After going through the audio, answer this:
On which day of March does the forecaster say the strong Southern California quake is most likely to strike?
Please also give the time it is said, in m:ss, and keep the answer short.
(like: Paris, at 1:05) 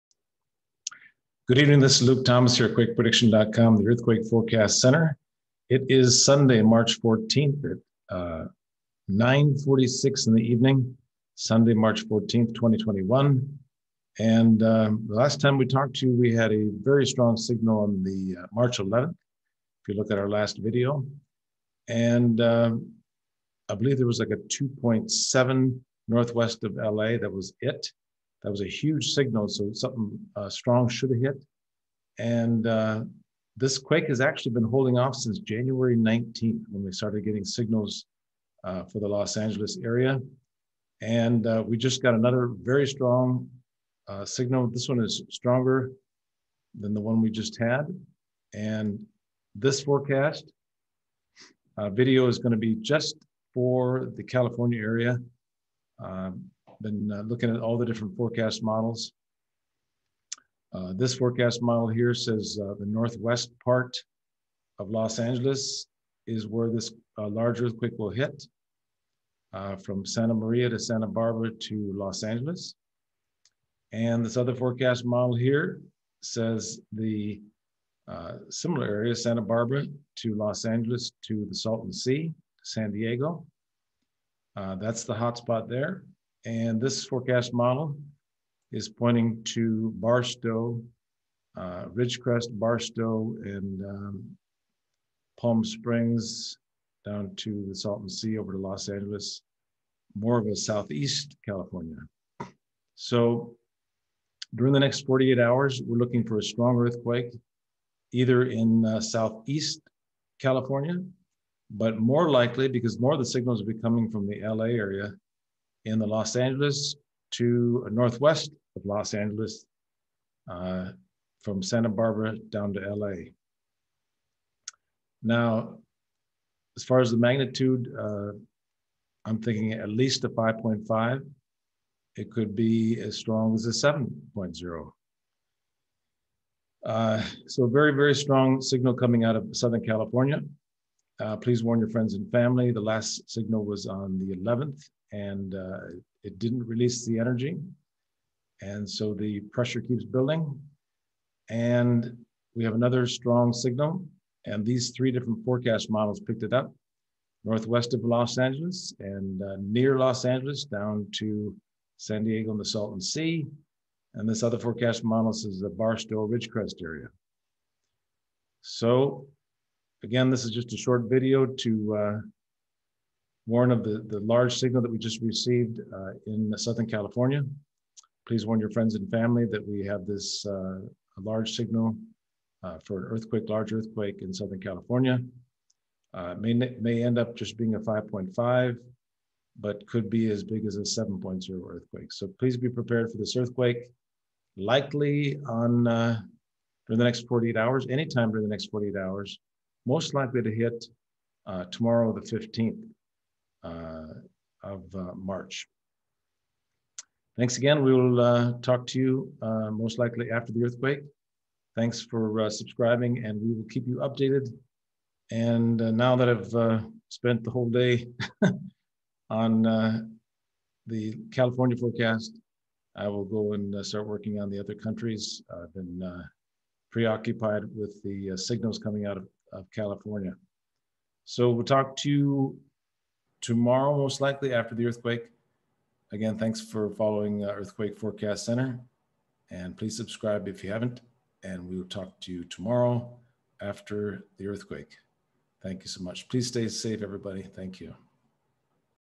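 15th, at 3:22.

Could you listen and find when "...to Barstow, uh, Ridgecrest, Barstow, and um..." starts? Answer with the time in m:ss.
1:29.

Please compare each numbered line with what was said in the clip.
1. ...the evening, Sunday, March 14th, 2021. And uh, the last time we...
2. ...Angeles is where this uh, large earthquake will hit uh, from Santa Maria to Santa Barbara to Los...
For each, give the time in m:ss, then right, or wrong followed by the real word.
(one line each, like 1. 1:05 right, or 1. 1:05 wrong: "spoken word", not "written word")
1. 0:10 right
2. 1:05 right.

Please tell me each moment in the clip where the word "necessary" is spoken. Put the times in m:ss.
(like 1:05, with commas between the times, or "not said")
not said.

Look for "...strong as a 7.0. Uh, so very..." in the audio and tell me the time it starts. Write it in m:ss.
2:13.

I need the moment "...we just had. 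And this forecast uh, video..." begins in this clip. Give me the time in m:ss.
0:47.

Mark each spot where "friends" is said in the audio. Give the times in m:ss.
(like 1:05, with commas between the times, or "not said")
2:21, 2:58.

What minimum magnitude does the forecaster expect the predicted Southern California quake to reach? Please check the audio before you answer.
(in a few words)
5.5.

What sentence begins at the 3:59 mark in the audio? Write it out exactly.
And please subscribe if you haven't.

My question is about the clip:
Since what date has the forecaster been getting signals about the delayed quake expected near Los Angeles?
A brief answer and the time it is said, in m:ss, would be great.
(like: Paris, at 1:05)
January 19th, at 0:35.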